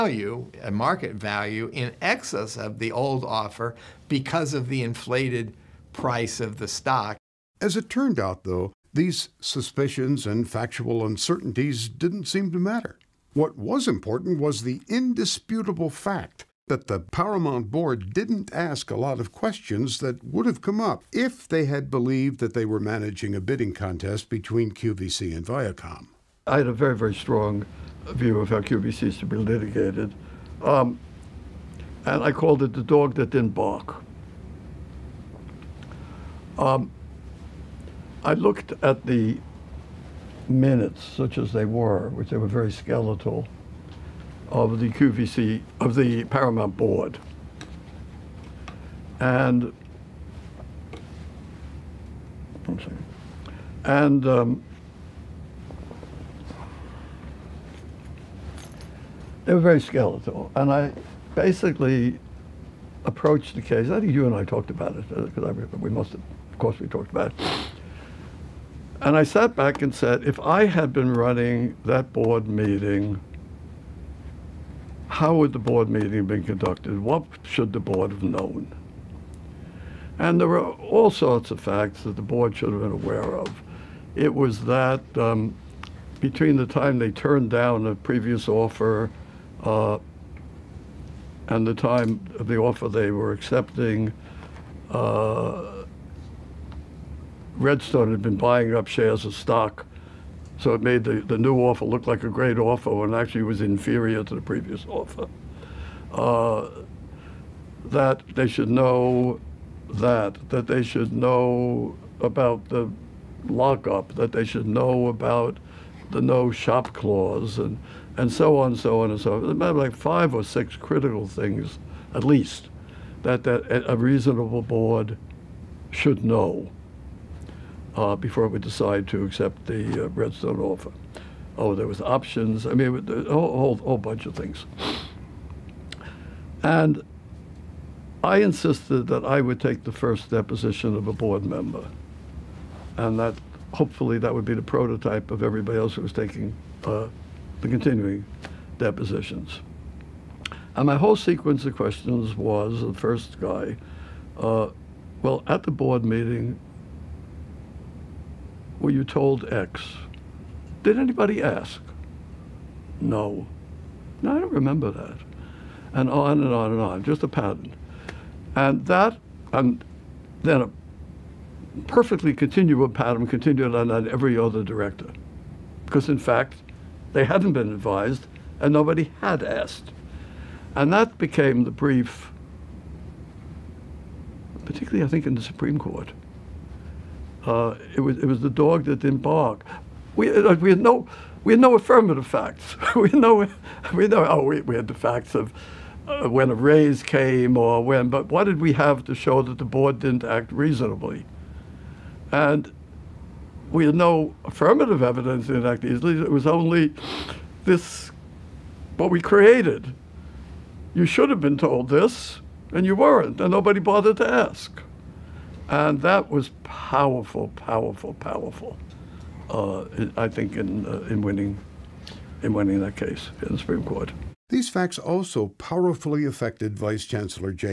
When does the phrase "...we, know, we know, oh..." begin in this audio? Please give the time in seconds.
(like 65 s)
192 s.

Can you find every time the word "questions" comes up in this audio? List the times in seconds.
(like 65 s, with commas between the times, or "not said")
19 s, 151 s.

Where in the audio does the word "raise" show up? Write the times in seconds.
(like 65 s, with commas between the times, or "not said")
196 s.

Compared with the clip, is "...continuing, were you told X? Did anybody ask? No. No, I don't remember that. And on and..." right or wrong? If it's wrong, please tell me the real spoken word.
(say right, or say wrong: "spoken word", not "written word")
wrong: "meeting", not "continuing".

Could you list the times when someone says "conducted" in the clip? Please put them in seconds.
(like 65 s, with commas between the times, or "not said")
76 s.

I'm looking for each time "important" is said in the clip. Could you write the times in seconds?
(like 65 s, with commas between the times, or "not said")
13 s.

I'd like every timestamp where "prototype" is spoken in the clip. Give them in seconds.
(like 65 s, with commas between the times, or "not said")
144 s.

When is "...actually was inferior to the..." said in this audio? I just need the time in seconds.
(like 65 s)
103 s.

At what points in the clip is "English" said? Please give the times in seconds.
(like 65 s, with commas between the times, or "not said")
not said.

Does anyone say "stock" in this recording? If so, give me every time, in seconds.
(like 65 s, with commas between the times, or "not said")
6 s, 99 s.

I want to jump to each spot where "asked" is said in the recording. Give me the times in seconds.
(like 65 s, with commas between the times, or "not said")
179 s.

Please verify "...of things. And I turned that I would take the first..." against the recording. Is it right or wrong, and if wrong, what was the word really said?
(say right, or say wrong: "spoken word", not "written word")
wrong: "insisted", not "turned".